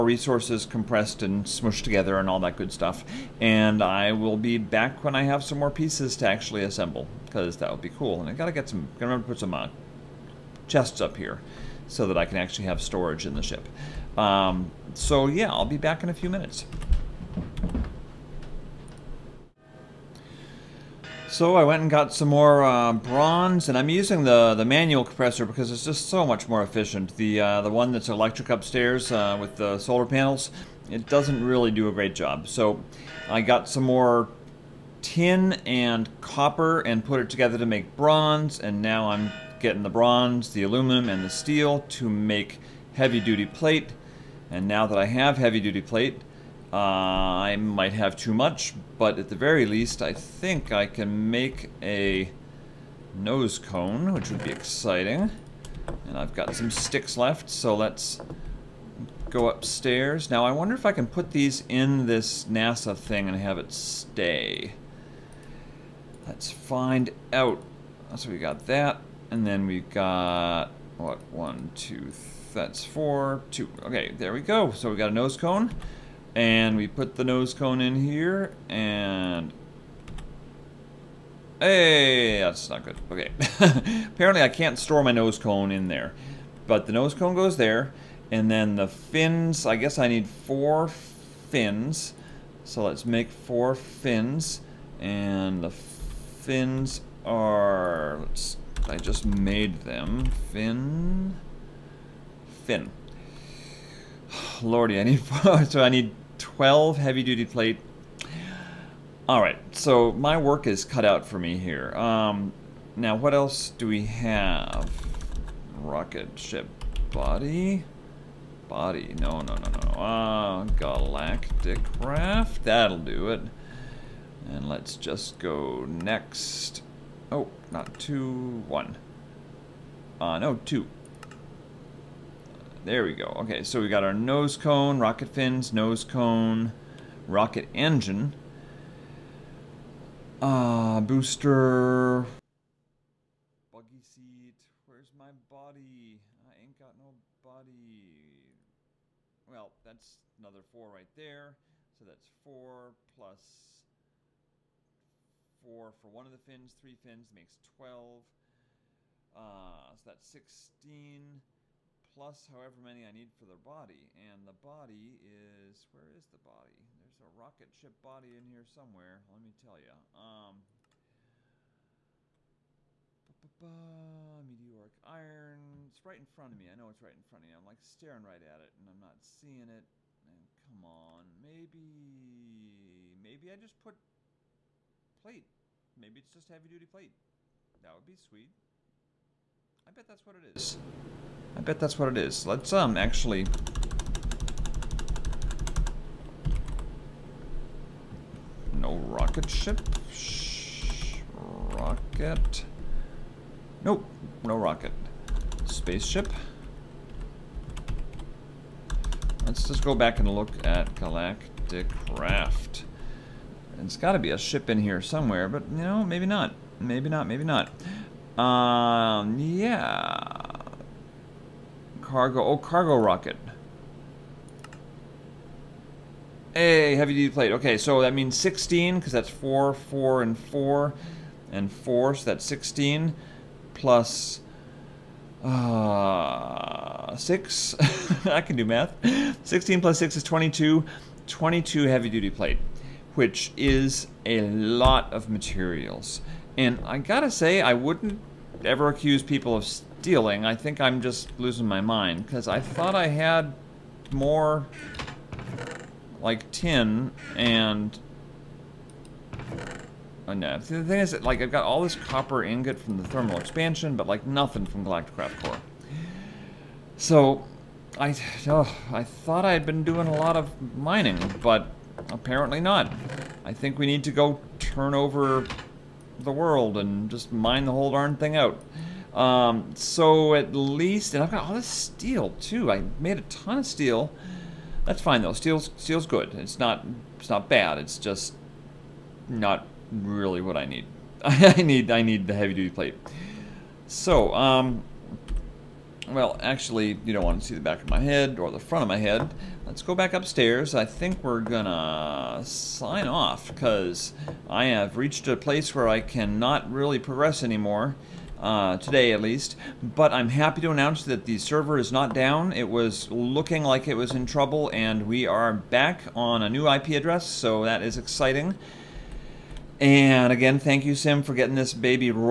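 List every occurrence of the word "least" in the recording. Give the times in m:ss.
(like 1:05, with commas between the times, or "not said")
0:49, 4:40, 5:09.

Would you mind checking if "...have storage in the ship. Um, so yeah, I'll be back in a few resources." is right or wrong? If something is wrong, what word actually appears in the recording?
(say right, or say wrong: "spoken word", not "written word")
wrong: "minutes", not "resources".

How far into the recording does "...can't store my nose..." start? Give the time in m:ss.
1:24.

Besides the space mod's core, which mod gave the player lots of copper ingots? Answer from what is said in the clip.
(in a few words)
thermal expansion.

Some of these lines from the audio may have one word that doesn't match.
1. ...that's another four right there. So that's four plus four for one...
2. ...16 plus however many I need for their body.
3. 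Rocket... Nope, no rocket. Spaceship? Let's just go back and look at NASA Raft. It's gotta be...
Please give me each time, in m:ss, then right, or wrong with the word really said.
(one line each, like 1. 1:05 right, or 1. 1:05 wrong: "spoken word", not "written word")
1. 2:29 right
2. 2:40 right
3. 3:21 wrong: "Galactic", not "NASA".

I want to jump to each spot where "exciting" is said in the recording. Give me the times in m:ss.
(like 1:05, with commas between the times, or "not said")
0:54, 5:17.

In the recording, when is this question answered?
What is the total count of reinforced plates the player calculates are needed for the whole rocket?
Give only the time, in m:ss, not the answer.
4:01.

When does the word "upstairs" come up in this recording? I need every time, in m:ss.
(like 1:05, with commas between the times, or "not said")
0:28, 0:59, 5:00.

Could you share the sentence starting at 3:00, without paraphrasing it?
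And come on, maybe, maybe I just put plate.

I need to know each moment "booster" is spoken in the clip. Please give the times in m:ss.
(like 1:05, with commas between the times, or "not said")
2:21.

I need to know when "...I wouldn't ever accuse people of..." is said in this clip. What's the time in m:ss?
4:07.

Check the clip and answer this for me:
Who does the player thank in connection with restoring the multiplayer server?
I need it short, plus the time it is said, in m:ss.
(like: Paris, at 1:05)
Sim, at 5:20.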